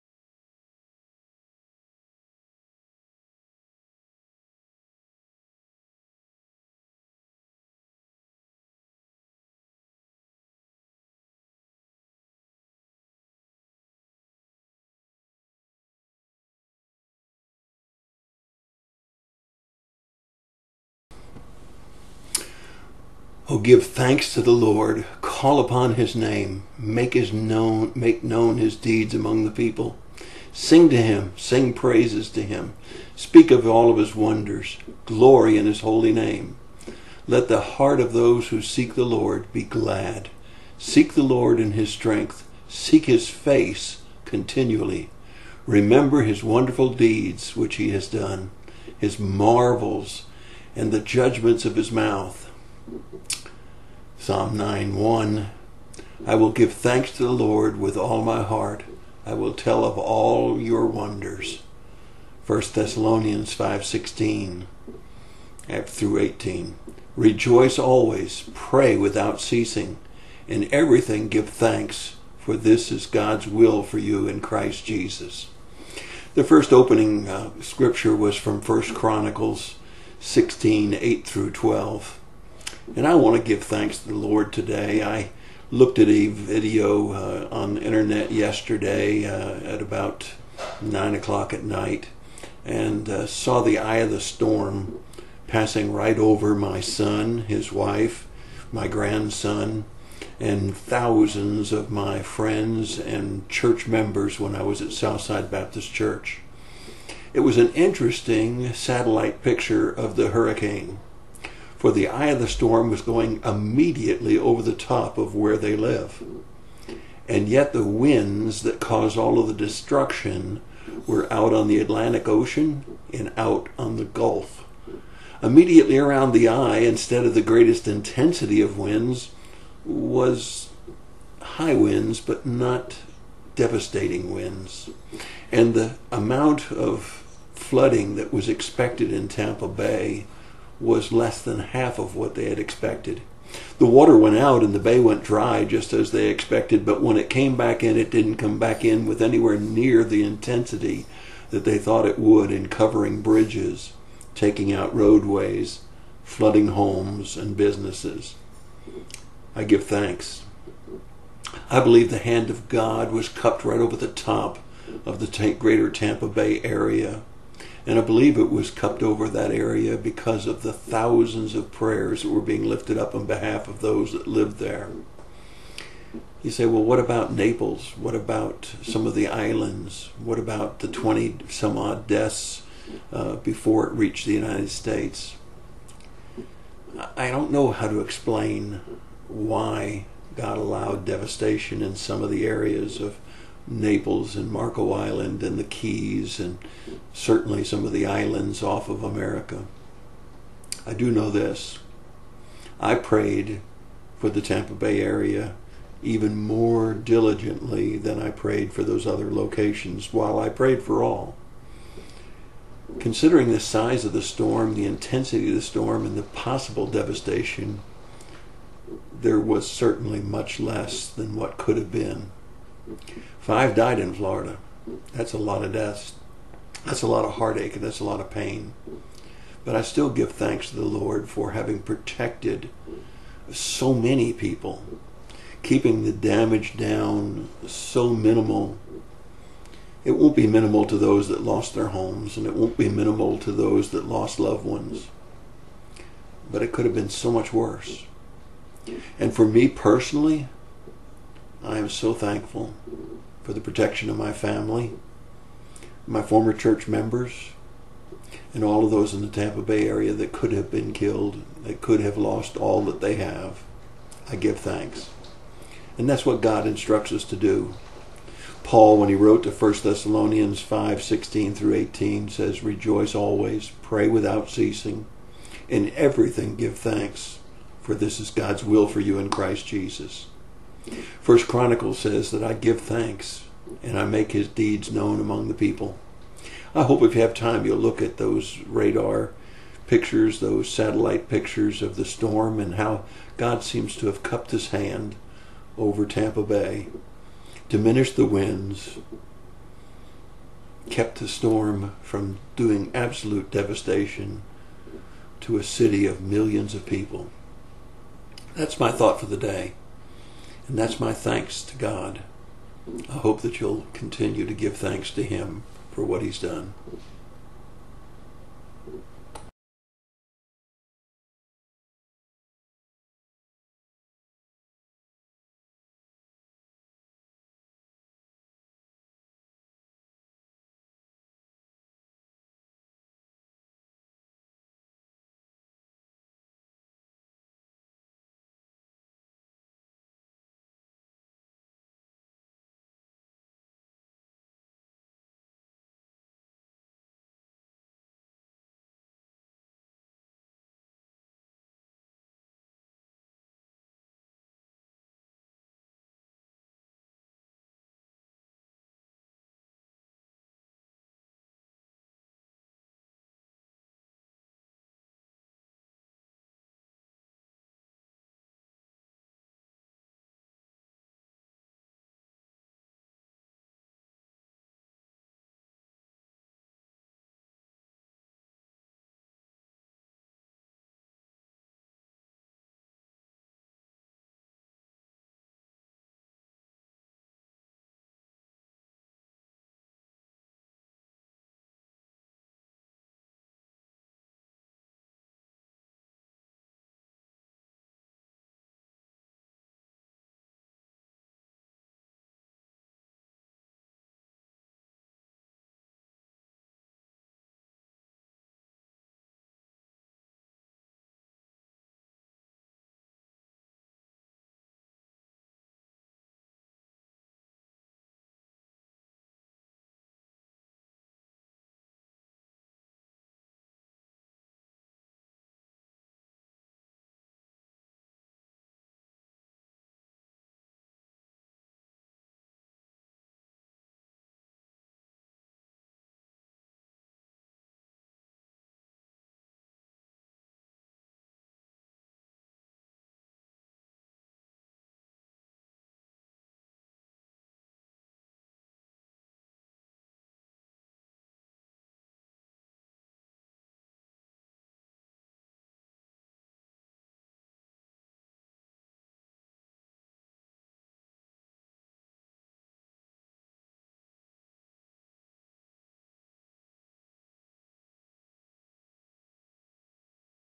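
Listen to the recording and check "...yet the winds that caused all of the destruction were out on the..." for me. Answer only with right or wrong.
right.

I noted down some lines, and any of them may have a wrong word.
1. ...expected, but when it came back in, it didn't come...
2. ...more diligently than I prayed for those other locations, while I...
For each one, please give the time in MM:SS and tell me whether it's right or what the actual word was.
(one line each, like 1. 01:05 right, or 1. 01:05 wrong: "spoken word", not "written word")
1. 02:26 right
2. 03:26 right.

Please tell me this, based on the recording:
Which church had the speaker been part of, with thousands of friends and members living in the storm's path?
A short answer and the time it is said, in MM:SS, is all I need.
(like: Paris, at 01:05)
Southside Baptist Church, at 01:44.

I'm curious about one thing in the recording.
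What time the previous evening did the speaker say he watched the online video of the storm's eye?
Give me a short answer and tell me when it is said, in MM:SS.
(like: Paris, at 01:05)
9 o'clock, at 01:30.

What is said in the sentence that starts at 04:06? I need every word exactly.
But it could have been so much worse.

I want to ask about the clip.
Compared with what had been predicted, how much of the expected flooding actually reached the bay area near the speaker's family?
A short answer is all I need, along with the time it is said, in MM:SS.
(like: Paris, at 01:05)
Less than half, at 02:21.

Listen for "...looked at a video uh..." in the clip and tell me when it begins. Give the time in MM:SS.
01:25.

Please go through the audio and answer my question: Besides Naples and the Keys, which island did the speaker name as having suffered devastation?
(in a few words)
Marco Island.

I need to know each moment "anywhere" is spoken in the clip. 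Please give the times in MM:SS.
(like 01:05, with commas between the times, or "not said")
02:29.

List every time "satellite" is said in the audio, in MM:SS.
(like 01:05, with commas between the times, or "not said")
01:48, 04:50.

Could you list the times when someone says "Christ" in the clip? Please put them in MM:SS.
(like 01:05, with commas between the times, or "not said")
01:14, 04:39.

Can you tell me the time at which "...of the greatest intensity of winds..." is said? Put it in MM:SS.
02:07.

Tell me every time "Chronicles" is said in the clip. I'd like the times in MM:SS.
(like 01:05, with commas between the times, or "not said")
01:18, 04:41.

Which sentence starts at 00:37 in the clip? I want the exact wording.
Let the heart of those who seek the Lord be glad.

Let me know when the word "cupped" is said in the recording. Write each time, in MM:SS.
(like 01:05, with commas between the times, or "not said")
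02:43, 02:48, 04:54.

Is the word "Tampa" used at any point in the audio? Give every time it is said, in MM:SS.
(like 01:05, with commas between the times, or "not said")
02:19, 02:45, 03:24, 04:19, 04:56.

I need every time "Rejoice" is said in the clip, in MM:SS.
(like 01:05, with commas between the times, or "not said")
01:07, 04:32.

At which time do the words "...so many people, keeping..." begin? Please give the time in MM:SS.
03:53.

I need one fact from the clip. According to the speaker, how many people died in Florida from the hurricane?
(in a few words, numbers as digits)
5.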